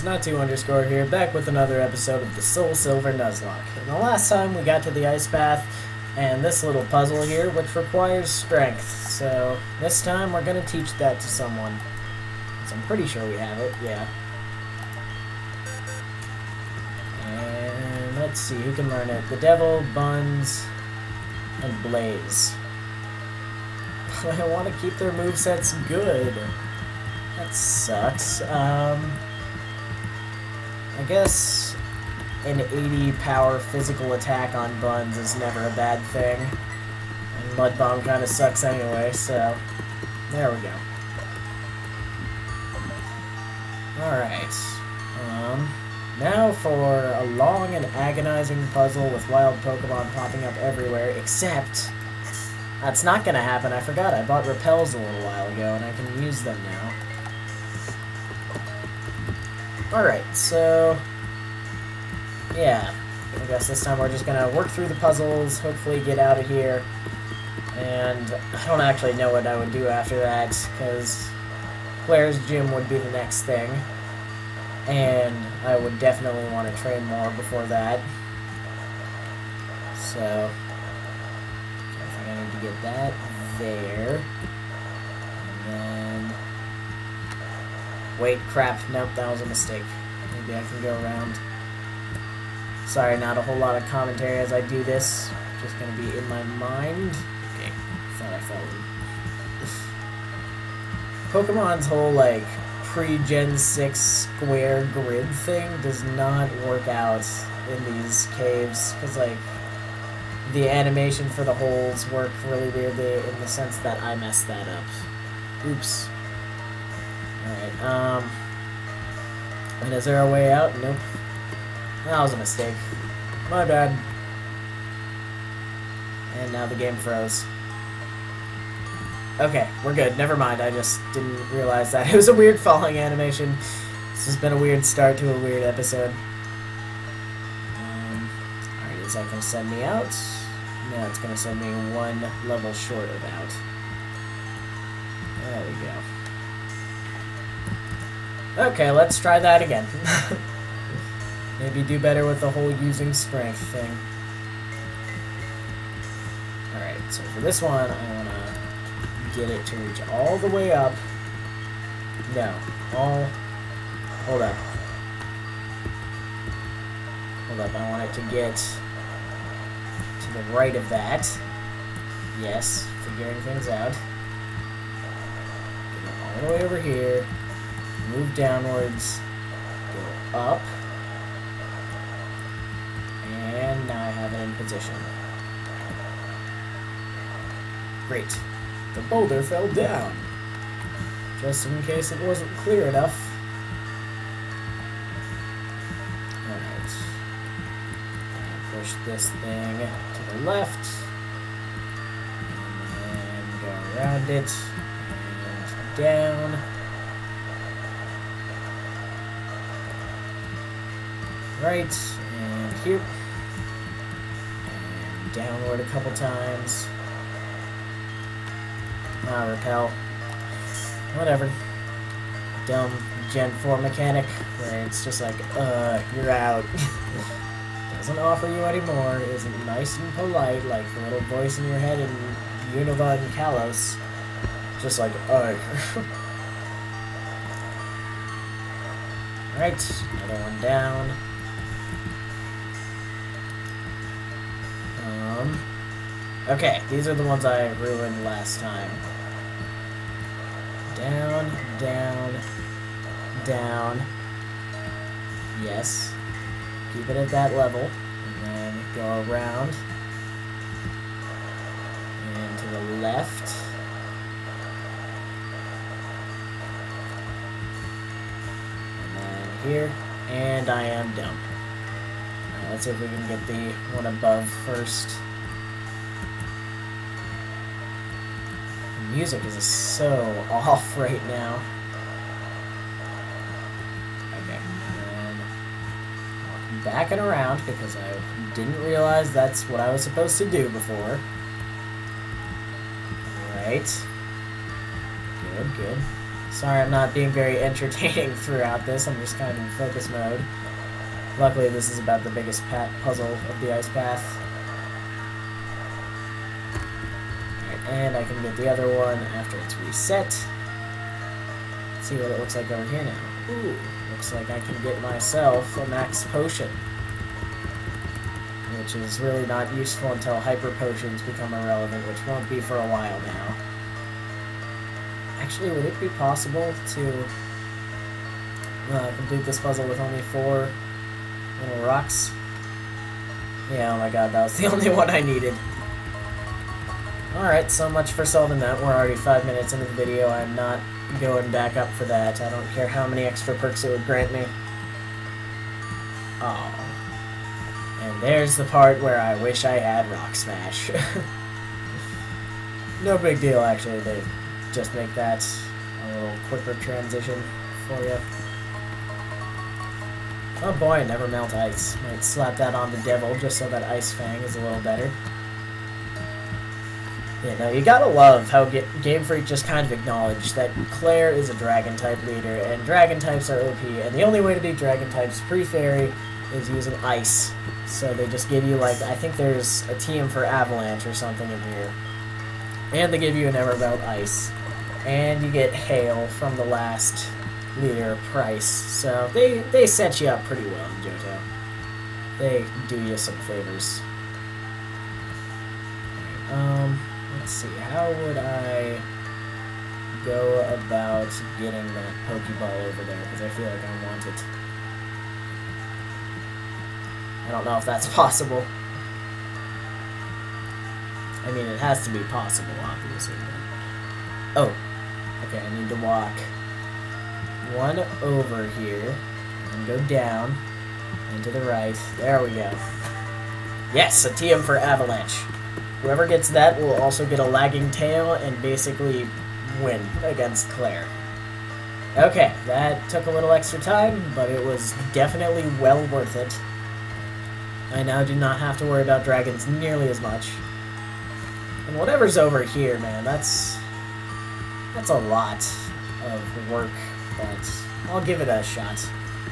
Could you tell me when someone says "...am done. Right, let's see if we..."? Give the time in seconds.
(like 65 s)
270 s.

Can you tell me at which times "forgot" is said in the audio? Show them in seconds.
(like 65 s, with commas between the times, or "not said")
53 s.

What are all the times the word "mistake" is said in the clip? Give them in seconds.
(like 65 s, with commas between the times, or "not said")
89 s, 122 s.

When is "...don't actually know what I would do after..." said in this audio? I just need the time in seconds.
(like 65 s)
68 s.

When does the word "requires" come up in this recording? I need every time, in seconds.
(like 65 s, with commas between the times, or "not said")
7 s.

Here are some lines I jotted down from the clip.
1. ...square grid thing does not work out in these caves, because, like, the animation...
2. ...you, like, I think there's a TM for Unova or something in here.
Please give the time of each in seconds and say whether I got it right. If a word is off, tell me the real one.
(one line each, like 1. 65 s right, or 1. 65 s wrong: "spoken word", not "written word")
1. 103 s right
2. 378 s wrong: "Avalanche", not "Unova".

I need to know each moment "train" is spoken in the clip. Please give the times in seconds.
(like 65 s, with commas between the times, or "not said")
76 s.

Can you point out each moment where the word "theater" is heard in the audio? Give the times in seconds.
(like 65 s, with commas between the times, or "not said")
not said.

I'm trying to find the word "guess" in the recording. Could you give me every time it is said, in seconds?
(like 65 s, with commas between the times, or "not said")
31 s, 63 s.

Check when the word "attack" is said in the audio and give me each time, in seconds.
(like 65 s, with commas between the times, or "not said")
34 s.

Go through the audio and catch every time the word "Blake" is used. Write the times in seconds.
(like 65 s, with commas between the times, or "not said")
not said.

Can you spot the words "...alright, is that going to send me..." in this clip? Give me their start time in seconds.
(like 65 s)
138 s.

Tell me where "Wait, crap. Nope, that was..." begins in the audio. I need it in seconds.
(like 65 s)
88 s.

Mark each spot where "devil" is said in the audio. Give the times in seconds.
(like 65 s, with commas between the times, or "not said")
19 s, 362 s.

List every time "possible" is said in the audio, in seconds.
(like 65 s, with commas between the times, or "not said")
326 s, 408 s, 412 s.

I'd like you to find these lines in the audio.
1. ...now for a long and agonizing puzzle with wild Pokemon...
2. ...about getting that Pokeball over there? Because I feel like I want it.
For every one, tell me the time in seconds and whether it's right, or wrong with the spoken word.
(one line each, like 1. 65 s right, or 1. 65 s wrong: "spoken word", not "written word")
1. 46 s right
2. 400 s right.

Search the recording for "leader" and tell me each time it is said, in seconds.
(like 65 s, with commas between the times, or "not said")
372 s, 387 s.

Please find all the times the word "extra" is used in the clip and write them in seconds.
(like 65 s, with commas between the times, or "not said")
343 s, 433 s.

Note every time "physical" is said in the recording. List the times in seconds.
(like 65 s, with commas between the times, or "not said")
33 s.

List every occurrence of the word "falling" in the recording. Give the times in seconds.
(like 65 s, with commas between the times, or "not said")
132 s.